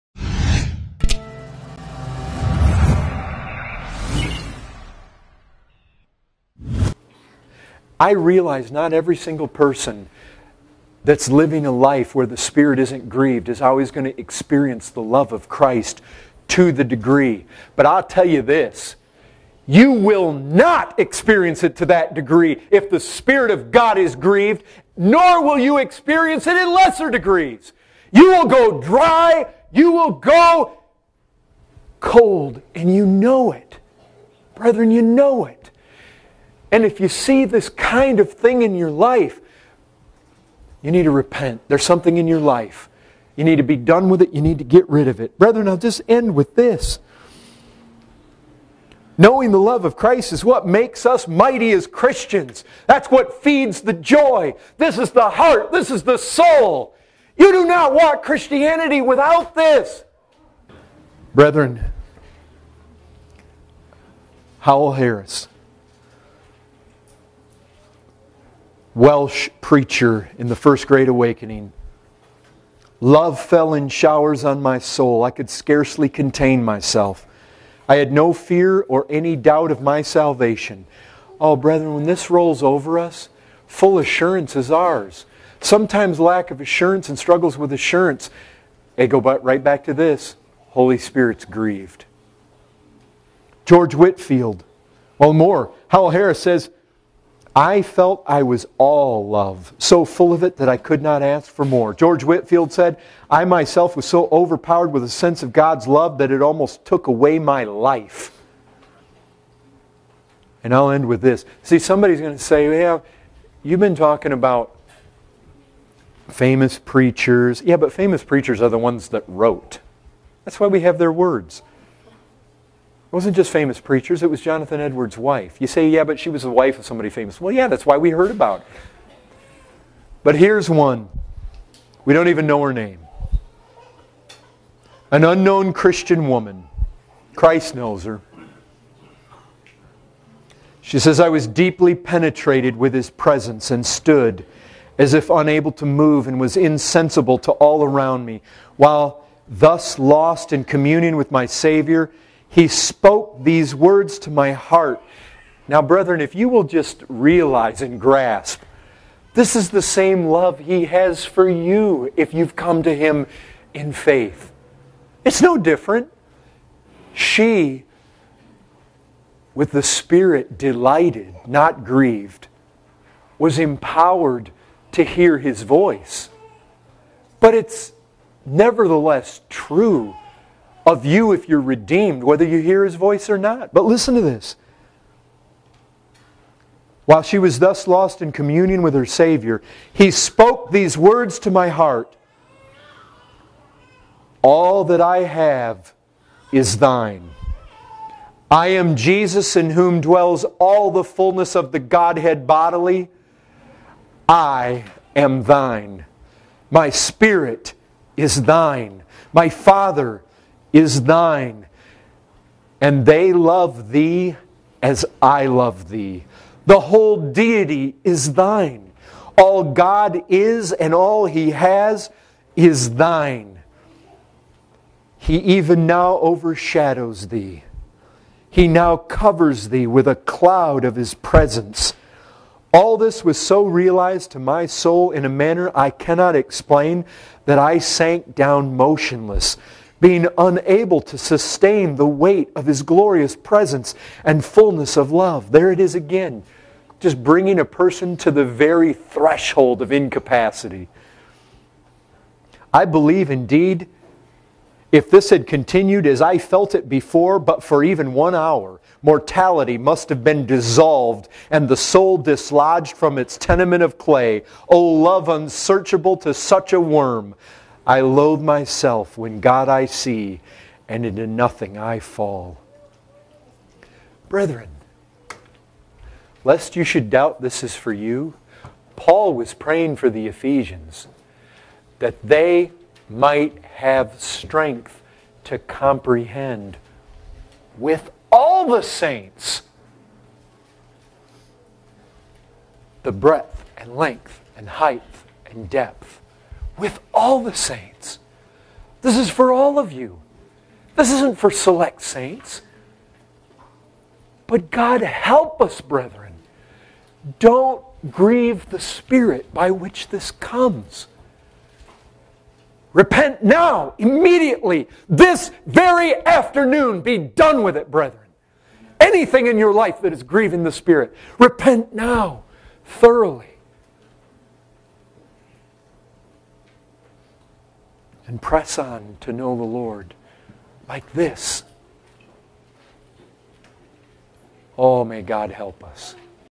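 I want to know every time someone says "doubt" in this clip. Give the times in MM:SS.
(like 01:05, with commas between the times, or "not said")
01:19, 04:37.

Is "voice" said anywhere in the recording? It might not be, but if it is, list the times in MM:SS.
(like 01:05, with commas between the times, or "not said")
02:55, 03:02.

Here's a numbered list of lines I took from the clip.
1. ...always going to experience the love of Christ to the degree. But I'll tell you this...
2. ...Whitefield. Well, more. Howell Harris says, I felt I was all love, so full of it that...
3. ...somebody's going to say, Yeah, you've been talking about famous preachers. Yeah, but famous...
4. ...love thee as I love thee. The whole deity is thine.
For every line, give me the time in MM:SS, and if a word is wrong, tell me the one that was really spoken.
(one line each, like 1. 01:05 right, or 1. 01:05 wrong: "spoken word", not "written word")
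1. 00:13 right
2. 01:33 right
3. 01:51 right
4. 03:33 right.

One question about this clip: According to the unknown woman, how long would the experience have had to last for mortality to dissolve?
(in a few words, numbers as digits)
one hour.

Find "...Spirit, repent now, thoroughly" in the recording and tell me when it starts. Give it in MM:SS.
05:20.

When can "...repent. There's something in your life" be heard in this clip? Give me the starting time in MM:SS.
00:41.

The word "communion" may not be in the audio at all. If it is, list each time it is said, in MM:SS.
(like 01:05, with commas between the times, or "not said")
02:30, 03:08.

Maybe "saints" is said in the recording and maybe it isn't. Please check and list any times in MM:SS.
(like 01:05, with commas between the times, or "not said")
04:48, 04:57, 05:02.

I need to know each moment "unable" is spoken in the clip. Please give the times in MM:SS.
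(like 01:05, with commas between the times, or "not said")
02:25, 04:00.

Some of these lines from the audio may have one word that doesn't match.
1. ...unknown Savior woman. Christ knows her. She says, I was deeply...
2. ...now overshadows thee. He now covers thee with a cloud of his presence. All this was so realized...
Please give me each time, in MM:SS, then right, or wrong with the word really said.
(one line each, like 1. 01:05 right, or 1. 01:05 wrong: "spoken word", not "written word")
1. 02:15 wrong: "Christian", not "Savior"
2. 03:45 right.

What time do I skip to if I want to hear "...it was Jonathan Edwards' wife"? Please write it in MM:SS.
02:04.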